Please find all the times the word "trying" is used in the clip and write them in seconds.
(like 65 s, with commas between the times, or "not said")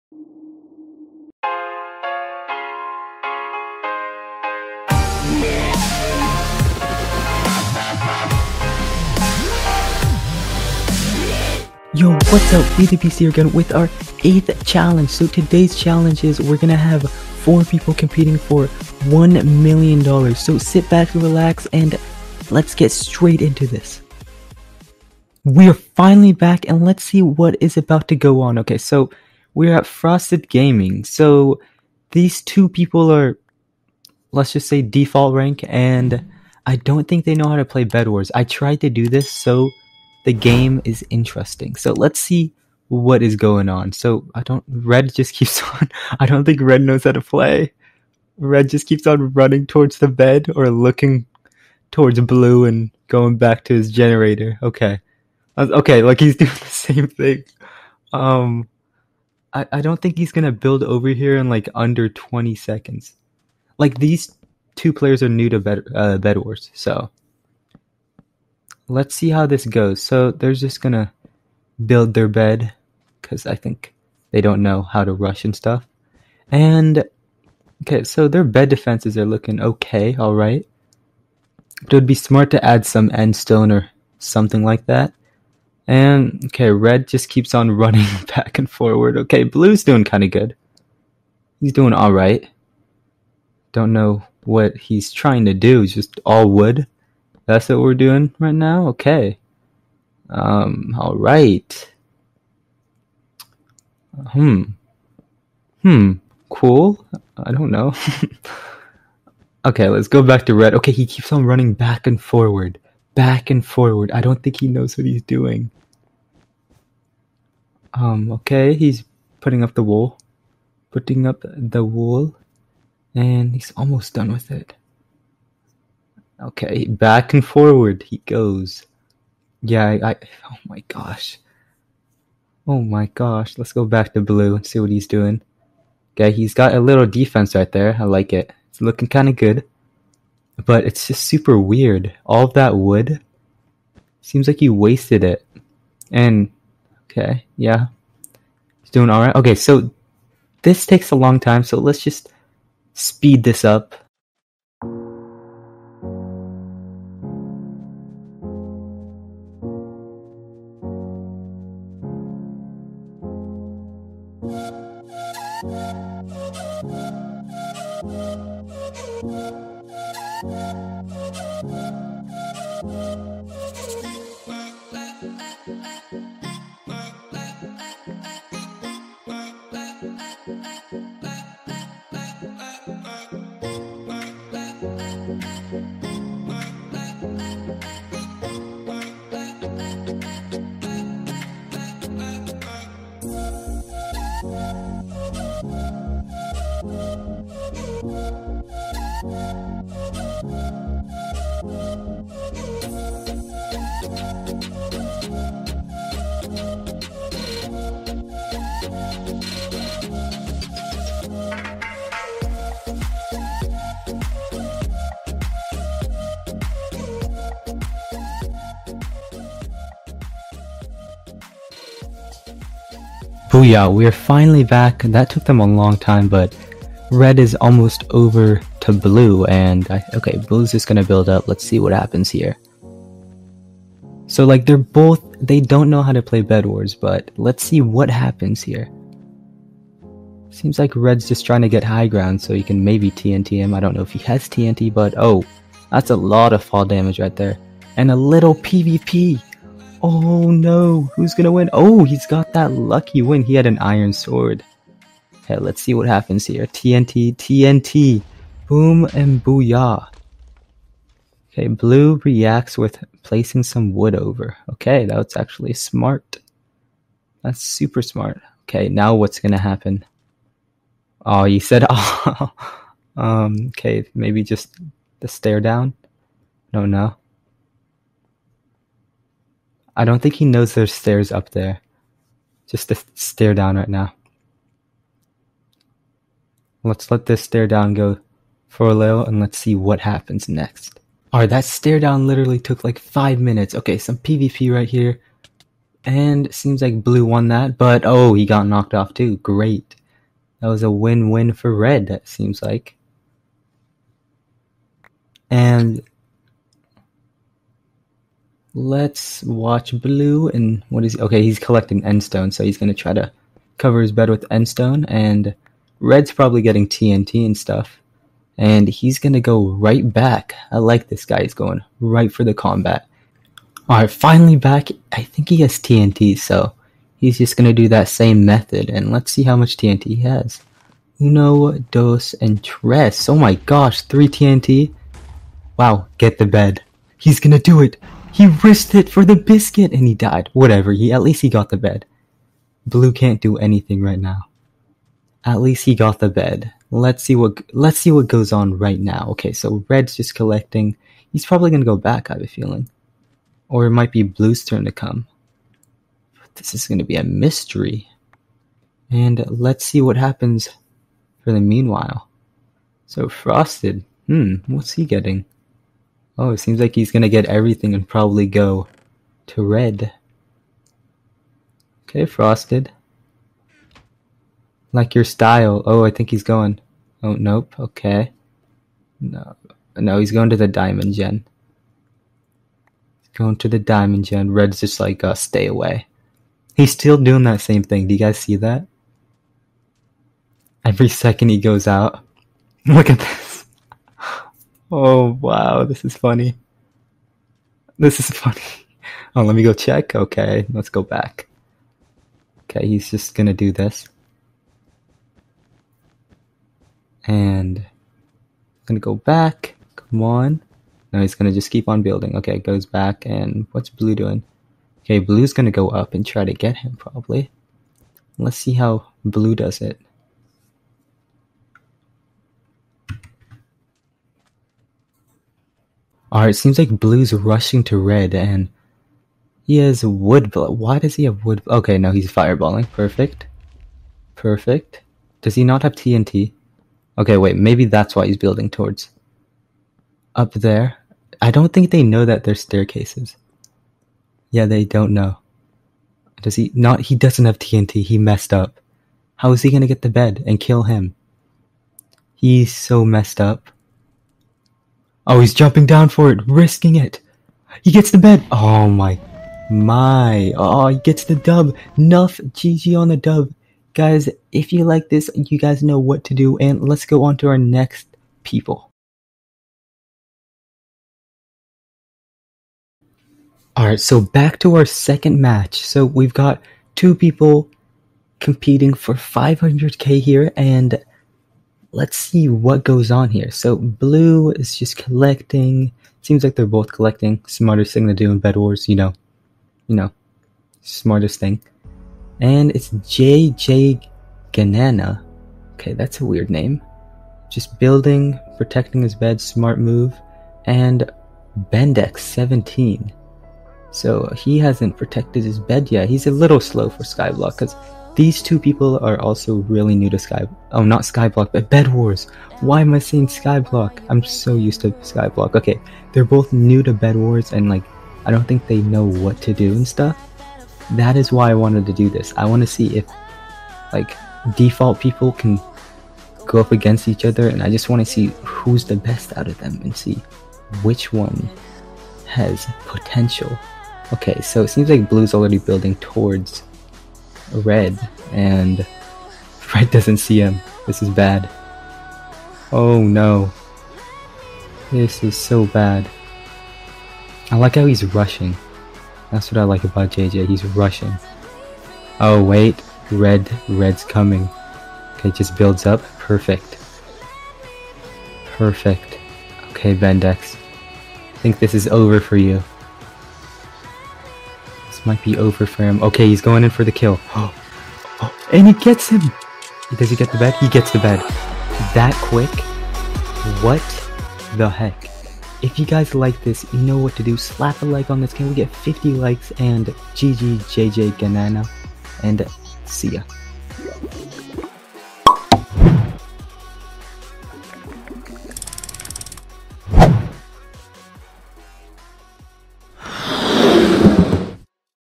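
95 s, 241 s.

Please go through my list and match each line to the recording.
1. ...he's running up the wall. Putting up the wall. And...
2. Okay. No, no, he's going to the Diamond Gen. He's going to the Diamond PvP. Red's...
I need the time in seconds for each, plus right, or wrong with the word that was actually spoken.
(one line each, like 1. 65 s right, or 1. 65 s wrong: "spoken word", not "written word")
1. 118 s wrong: "putting", not "running"
2. 377 s wrong: "Gen", not "PvP".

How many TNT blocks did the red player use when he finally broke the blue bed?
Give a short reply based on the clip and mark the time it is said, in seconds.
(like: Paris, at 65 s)
3, at 334 s.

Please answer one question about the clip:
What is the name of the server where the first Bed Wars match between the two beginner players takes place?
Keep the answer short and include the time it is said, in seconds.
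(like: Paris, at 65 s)
Frosted Gaming, at 29 s.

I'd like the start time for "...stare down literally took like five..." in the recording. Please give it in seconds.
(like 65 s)
291 s.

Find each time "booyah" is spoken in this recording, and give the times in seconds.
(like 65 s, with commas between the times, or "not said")
223 s, 259 s.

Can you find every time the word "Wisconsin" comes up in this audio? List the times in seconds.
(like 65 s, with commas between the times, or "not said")
not said.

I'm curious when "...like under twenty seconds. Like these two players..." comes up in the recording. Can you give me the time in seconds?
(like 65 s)
61 s.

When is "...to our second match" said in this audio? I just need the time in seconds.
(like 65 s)
474 s.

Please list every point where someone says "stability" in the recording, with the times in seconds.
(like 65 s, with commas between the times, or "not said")
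not said.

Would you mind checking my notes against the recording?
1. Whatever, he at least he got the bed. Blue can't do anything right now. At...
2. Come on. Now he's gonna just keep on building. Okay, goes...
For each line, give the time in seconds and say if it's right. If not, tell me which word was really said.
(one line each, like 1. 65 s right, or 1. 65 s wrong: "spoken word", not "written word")
1. 340 s right
2. 409 s right.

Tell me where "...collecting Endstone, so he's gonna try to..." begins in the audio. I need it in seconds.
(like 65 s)
311 s.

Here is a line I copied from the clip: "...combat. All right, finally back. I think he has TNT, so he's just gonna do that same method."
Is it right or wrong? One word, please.
right.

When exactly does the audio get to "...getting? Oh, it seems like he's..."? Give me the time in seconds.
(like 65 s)
365 s.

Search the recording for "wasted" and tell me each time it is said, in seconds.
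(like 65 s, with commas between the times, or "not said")
144 s.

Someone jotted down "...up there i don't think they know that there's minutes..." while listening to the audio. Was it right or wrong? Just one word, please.
wrong.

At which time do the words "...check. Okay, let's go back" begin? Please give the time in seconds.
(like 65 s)
399 s.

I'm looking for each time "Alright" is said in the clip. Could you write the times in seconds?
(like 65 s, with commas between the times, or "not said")
291 s, 473 s.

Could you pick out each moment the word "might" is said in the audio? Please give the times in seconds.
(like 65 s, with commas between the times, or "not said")
353 s, 565 s.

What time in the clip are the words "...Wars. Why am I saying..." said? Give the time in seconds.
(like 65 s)
511 s.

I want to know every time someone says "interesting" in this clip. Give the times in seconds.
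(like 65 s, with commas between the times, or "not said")
41 s.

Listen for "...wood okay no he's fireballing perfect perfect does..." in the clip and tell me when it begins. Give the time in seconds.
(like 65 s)
431 s.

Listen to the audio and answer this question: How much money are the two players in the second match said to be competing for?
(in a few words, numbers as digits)
500k.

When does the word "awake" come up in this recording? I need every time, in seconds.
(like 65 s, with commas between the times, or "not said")
not said.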